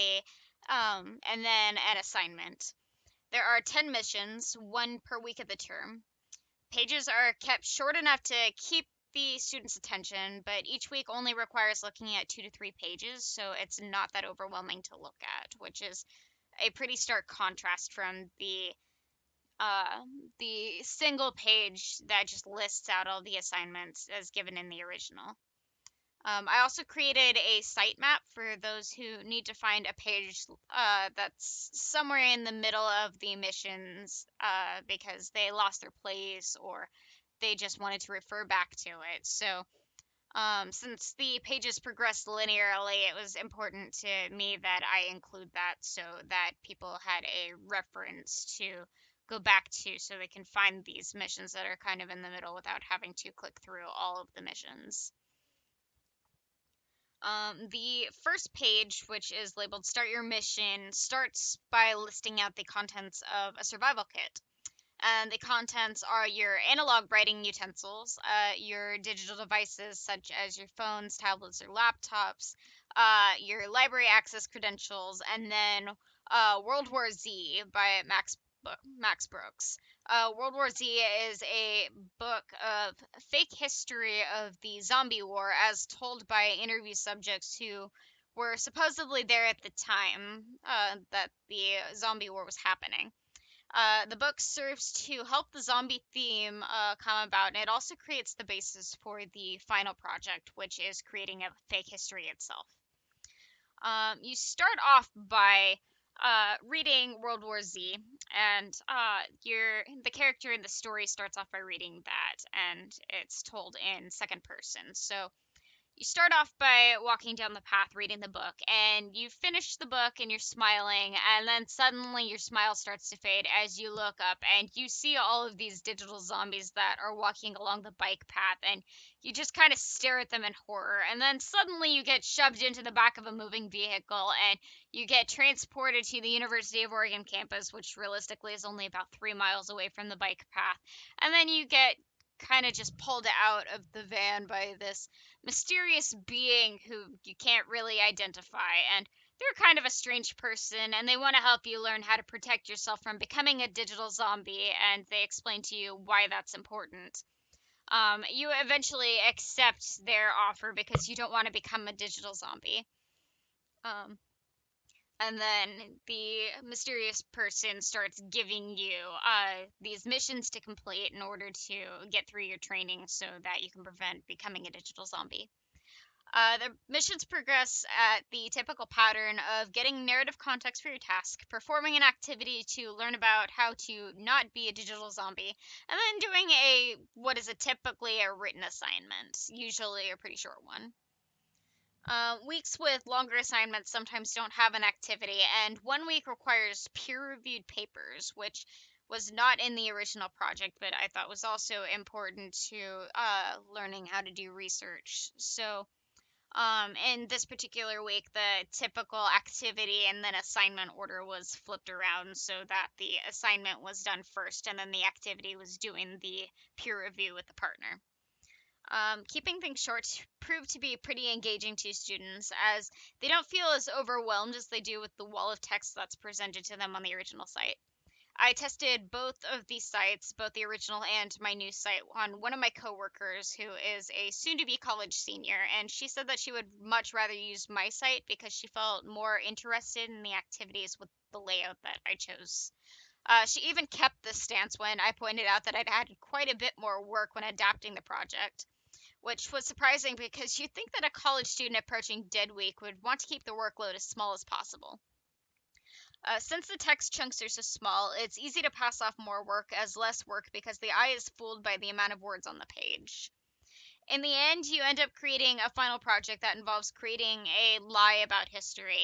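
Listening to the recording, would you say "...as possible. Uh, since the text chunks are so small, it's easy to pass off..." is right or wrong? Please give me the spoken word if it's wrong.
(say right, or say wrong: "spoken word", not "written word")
right.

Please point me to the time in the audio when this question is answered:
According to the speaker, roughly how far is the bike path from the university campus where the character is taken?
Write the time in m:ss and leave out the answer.
2:19.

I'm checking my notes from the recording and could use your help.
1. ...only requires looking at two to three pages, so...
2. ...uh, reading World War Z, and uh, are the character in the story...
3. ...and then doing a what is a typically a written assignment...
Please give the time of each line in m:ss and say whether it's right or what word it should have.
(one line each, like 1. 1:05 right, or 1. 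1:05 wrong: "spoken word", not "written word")
1. 0:11 right
2. 1:46 right
3. 3:05 right.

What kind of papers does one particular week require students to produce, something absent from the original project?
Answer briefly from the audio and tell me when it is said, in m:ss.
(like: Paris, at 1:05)
Peer reviewed papers, at 3:16.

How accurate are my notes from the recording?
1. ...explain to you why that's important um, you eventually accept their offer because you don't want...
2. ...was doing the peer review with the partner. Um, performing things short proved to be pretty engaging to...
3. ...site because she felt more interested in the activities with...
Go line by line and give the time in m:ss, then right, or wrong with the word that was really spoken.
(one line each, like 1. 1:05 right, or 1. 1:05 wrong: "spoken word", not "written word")
1. 2:35 right
2. 3:35 wrong: "keeping", not "performing"
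3. 3:57 right.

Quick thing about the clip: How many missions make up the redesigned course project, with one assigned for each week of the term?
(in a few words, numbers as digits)
10.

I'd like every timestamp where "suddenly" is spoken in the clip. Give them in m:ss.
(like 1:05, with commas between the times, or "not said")
2:01, 2:11.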